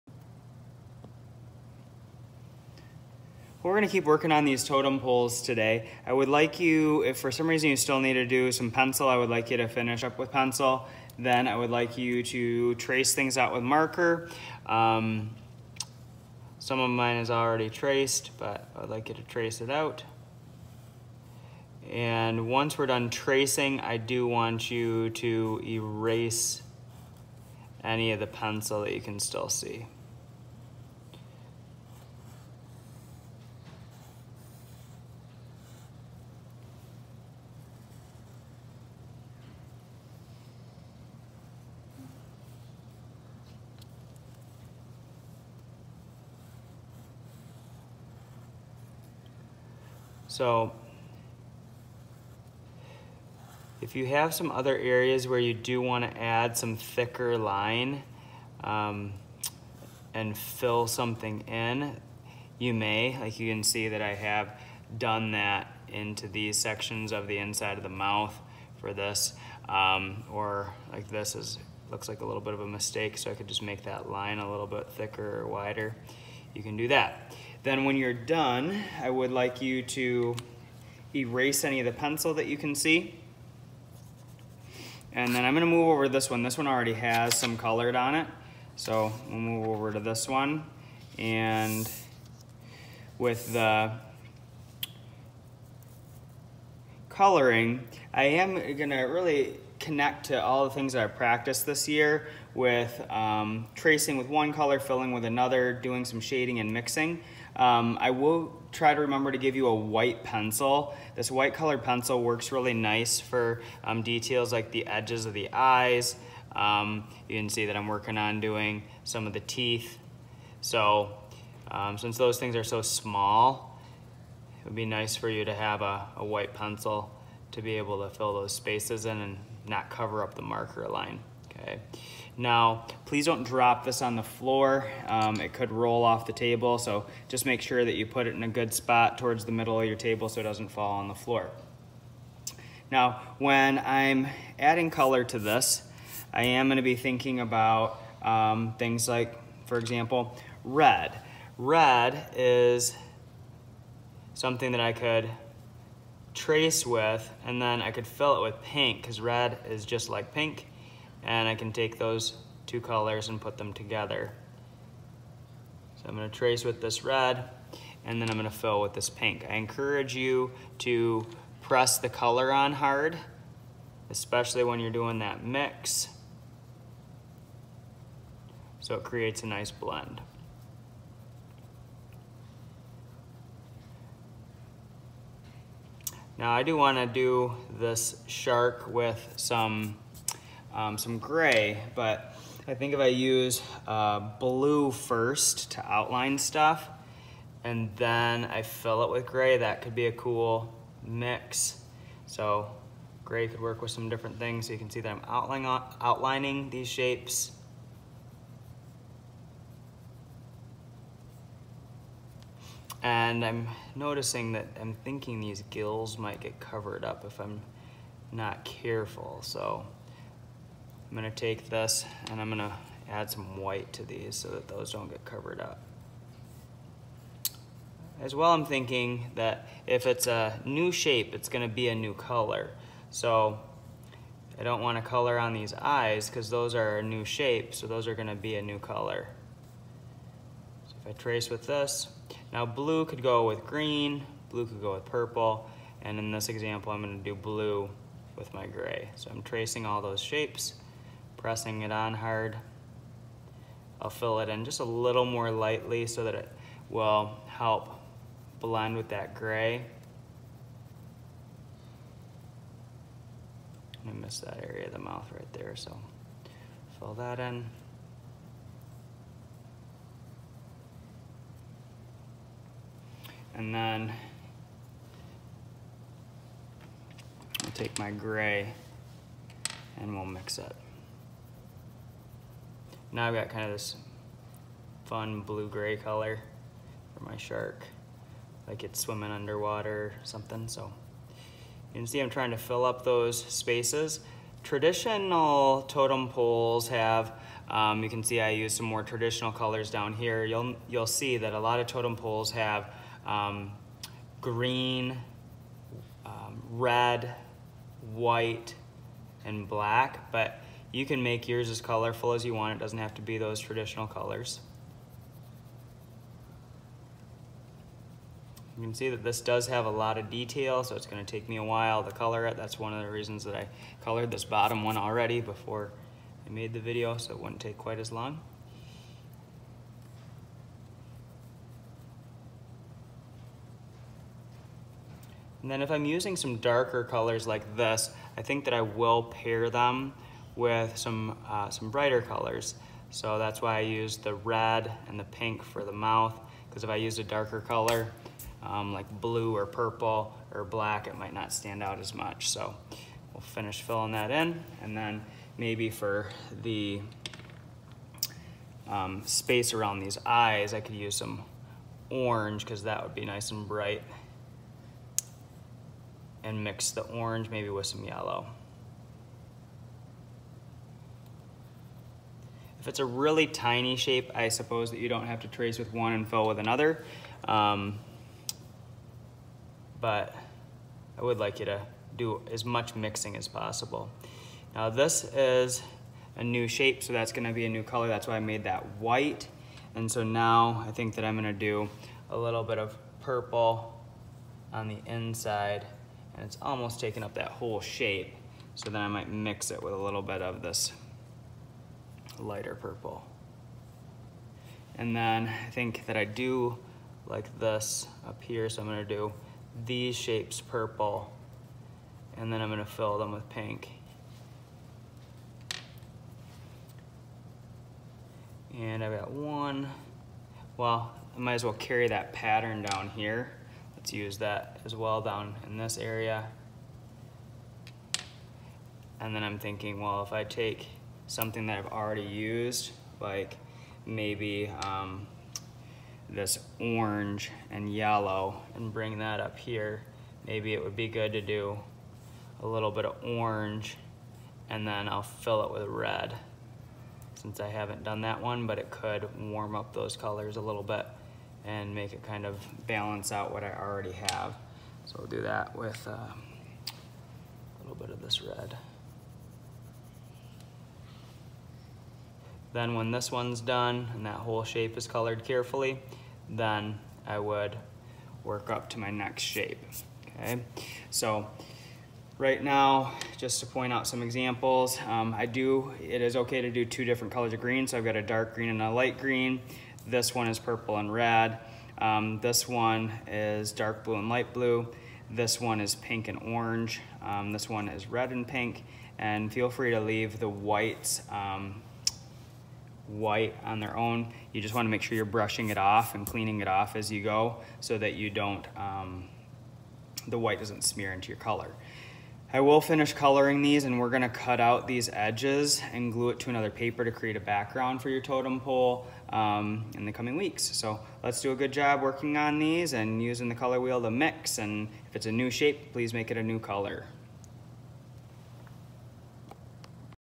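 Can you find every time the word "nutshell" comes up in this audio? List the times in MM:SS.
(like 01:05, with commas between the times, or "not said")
not said.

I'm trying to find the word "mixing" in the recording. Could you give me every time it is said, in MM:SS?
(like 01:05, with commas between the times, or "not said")
01:46, 06:22.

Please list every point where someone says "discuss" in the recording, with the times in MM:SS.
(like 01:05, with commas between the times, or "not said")
not said.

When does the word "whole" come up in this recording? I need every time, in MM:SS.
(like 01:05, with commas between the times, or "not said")
06:37, 07:44.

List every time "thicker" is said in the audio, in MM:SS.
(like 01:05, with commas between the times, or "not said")
00:56, 01:14.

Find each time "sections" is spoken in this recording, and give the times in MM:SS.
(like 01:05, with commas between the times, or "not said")
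01:06.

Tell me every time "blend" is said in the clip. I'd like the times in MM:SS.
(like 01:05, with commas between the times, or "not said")
02:59, 04:18.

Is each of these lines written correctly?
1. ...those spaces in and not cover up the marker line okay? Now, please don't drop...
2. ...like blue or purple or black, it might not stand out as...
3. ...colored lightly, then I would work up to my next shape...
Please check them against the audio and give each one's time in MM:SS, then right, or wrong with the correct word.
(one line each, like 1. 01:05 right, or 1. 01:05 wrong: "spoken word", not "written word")
1. 02:08 right
2. 05:48 right
3. 07:45 wrong: "carefully", not "lightly".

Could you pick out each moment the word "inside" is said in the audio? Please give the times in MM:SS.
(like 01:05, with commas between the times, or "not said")
01:07, 06:35.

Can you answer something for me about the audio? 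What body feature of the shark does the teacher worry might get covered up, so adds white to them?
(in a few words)
gills.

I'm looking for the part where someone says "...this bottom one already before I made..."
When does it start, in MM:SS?
05:24.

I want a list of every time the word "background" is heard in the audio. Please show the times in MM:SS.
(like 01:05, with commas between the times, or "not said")
08:27.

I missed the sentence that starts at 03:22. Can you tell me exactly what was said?
So gray could work with some different things.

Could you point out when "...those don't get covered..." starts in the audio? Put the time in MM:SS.
03:44.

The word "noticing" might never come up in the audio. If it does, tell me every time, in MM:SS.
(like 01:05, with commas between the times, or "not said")
03:33.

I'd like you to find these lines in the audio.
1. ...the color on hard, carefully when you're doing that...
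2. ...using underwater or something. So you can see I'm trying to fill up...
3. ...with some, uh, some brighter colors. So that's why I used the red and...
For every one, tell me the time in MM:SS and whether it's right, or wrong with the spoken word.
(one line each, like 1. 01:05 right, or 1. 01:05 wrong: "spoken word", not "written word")
1. 02:51 wrong: "especially", not "carefully"
2. 04:49 wrong: "swimming", not "using"
3. 05:40 right.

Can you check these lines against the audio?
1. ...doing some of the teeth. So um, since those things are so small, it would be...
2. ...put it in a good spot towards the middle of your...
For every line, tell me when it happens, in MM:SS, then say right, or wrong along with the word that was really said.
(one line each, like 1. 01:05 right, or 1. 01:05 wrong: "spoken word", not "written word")
1. 01:58 right
2. 02:18 right.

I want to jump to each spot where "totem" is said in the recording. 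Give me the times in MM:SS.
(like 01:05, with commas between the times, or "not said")
00:04, 04:55, 05:01, 08:28.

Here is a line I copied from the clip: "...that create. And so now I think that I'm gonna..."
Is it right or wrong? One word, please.
wrong.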